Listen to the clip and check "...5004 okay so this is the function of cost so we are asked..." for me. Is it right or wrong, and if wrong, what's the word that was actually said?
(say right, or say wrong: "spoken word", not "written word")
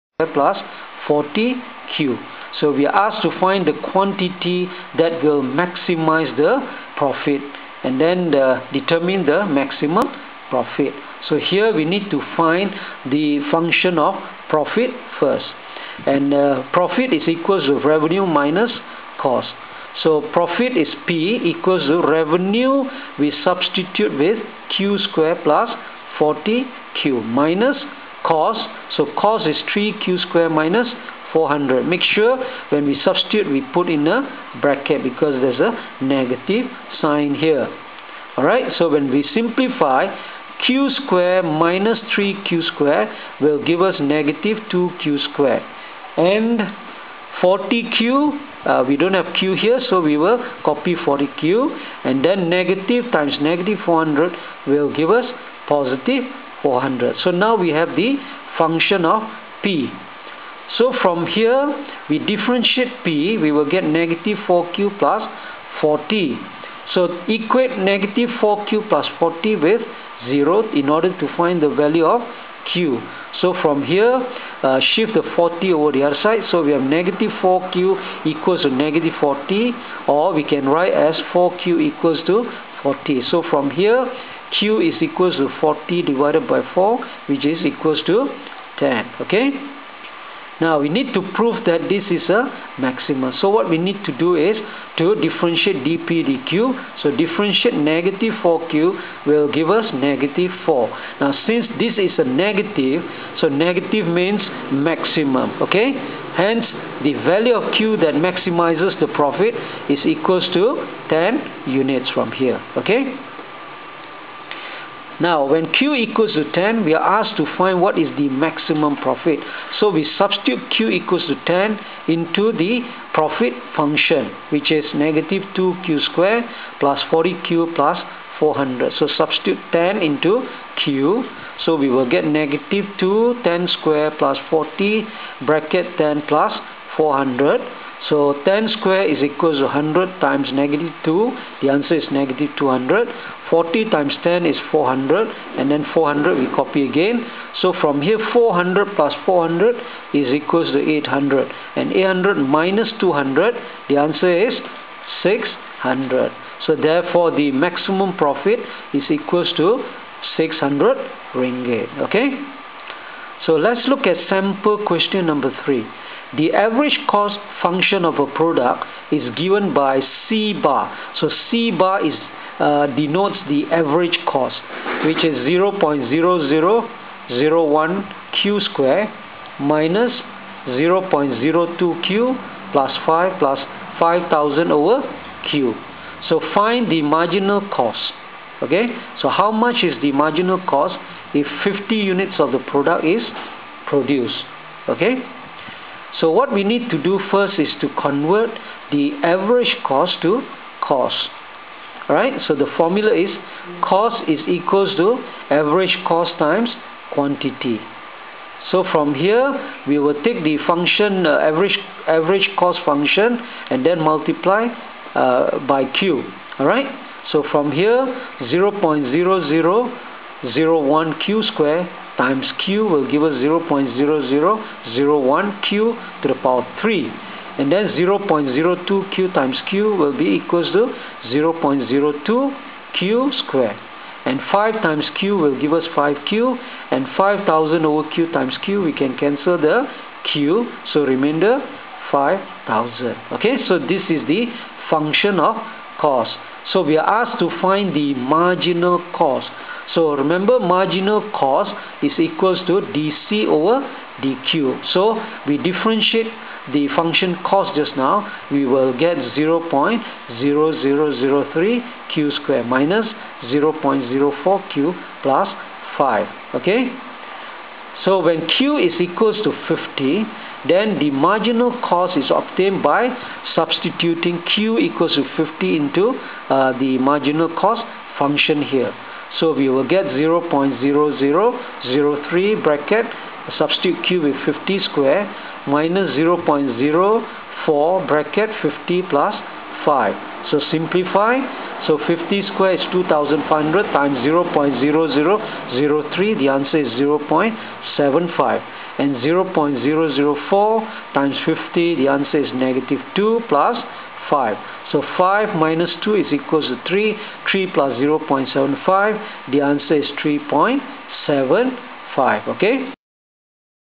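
wrong: "5000", not "5004".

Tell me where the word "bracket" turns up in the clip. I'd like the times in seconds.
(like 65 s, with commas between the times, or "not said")
34 s, 135 s.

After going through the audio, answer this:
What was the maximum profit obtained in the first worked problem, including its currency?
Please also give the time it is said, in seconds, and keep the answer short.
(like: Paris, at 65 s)
600 ringgit, at 160 s.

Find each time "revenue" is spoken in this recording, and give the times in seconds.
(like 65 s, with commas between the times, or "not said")
17 s, 22 s.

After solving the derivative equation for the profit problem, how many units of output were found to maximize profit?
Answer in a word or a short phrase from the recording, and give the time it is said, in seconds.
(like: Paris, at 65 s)
10, at 84 s.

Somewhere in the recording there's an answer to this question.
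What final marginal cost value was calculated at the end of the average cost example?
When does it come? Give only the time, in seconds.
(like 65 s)
310 s.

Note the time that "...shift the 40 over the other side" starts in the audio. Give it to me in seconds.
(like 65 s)
74 s.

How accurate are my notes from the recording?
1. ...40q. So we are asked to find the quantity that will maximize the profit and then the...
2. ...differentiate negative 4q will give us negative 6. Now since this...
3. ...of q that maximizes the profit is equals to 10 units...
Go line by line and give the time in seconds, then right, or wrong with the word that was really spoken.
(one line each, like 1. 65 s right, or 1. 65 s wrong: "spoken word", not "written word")
1. 1 s right
2. 97 s wrong: "4", not "6"
3. 107 s right.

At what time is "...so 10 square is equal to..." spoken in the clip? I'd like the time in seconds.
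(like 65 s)
138 s.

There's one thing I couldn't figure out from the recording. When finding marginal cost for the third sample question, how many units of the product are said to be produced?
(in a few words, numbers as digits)
50.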